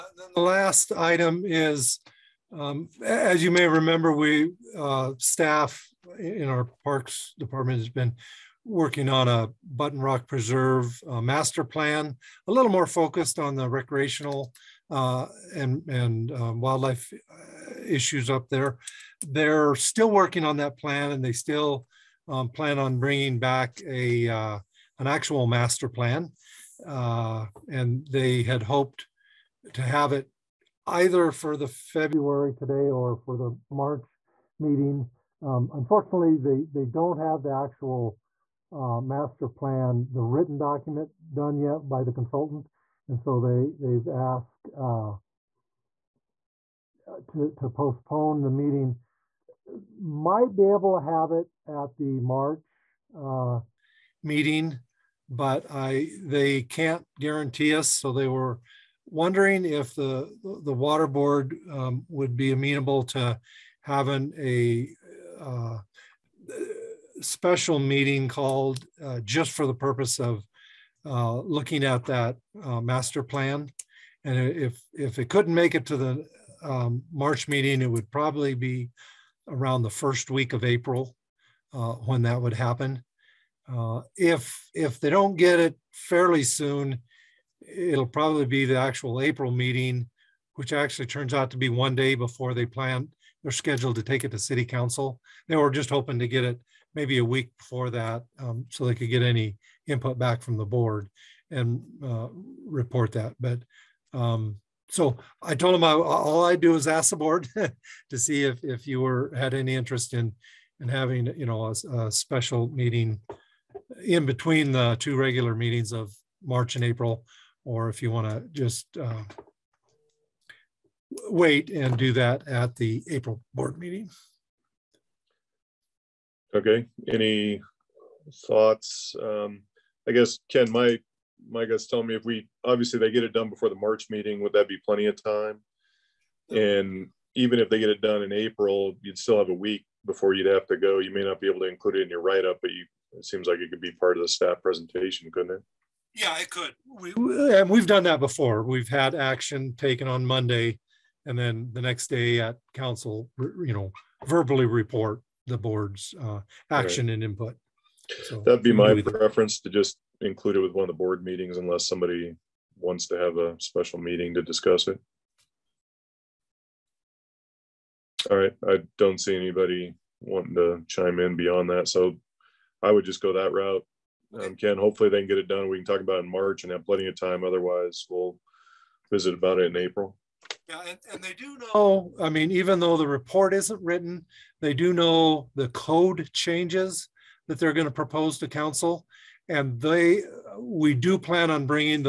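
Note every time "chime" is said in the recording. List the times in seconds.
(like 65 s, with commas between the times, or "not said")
170 s.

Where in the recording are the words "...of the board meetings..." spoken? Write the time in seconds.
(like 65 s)
160 s.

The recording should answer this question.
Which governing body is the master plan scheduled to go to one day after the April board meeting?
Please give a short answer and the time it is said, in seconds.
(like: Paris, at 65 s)
City Council, at 94 s.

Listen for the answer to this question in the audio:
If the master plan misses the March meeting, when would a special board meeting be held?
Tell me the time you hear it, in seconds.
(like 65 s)
79 s.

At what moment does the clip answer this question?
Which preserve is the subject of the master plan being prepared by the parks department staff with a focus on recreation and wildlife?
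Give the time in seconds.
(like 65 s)
9 s.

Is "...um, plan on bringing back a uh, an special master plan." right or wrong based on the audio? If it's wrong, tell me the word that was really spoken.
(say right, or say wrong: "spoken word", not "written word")
wrong: "actual", not "special".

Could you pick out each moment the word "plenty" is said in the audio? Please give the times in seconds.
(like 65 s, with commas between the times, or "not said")
134 s, 176 s.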